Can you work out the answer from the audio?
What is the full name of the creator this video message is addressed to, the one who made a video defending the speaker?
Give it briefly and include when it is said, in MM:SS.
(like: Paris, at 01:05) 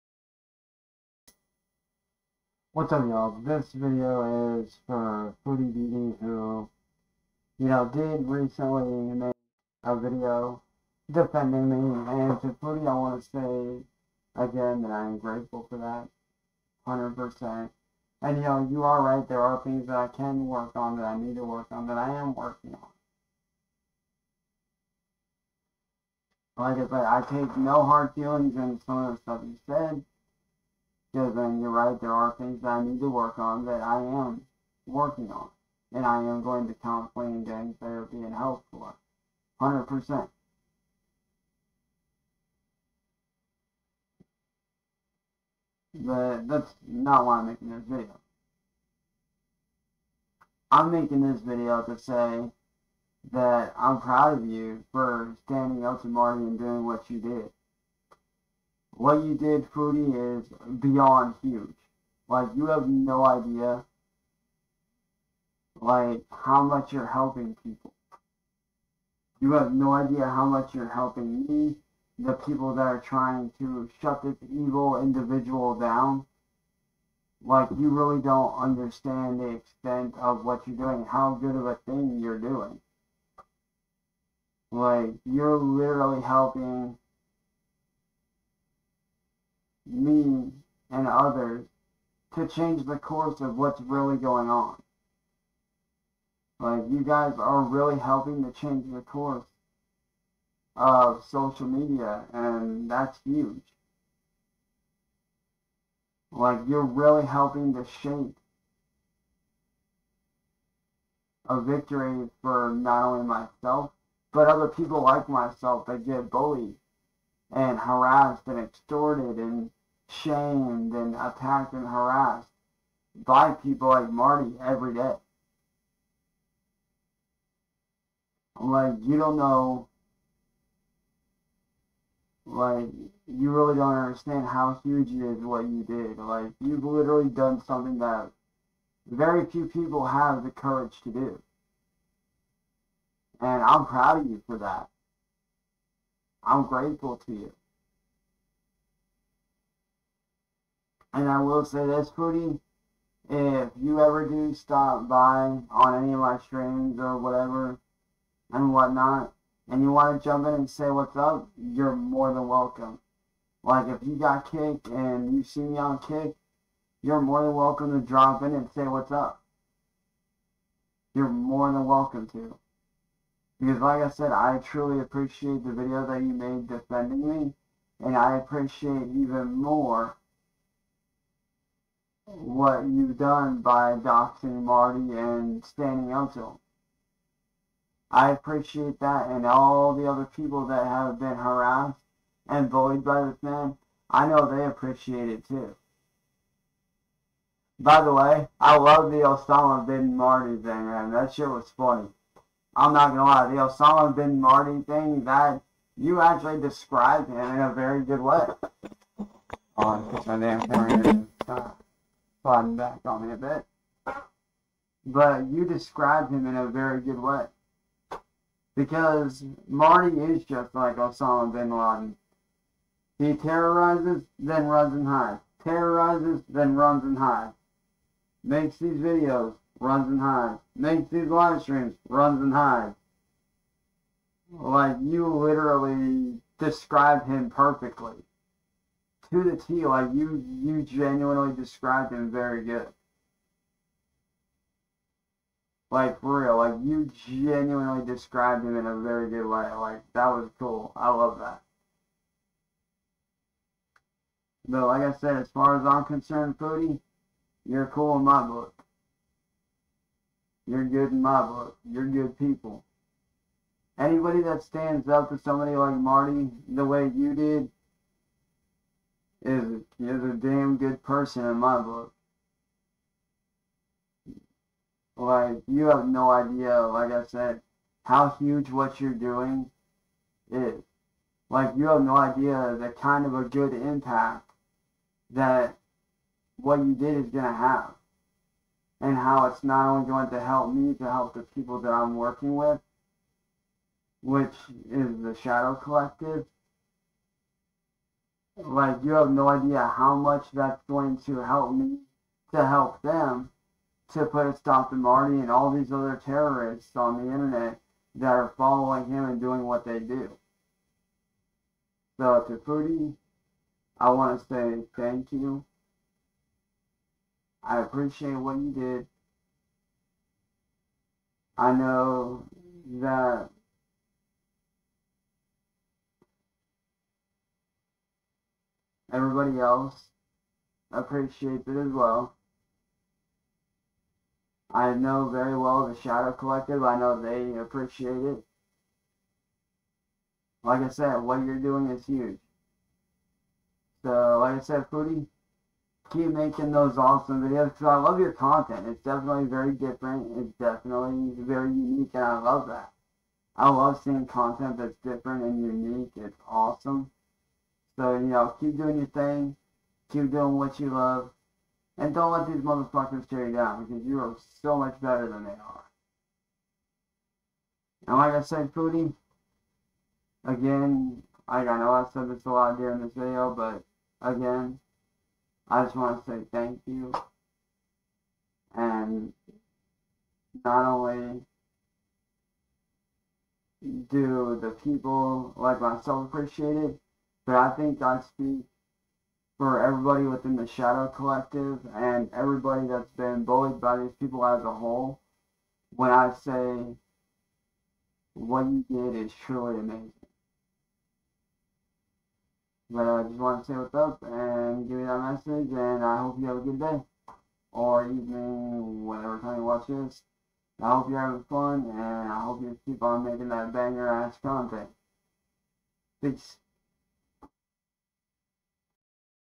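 Foodie Beauty, at 00:05.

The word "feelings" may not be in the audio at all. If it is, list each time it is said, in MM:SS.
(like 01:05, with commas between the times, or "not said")
00:28.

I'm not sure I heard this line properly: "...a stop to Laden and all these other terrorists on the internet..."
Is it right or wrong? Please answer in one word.
wrong.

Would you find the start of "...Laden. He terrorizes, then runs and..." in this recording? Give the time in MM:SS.
03:41.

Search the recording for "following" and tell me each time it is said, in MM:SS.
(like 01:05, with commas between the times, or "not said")
05:08.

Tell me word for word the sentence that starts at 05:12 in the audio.
So to Foodie, I want to say thank you.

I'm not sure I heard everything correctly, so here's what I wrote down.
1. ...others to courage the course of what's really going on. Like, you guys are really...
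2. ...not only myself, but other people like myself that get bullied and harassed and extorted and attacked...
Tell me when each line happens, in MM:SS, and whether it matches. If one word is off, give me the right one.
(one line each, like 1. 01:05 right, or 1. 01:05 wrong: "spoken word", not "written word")
1. 01:31 wrong: "change", not "courage"
2. 01:52 wrong: "shamed", not "attacked".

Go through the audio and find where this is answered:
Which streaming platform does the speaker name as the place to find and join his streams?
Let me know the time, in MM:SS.
02:45.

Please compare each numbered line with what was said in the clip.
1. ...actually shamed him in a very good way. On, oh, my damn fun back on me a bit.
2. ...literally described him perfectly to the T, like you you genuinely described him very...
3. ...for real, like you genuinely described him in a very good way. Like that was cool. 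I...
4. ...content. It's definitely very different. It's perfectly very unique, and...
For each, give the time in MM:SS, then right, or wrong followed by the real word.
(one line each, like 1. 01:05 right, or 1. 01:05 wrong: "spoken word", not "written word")
1. 03:26 wrong: "described", not "shamed"
2. 03:55 right
3. 04:06 right
4. 05:48 wrong: "definitely", not "perfectly".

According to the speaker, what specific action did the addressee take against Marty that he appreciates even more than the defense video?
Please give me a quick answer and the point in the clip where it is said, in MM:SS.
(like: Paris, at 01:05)
Doxing, at 03:03.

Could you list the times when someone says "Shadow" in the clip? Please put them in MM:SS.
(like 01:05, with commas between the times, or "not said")
04:55, 05:35, 06:30.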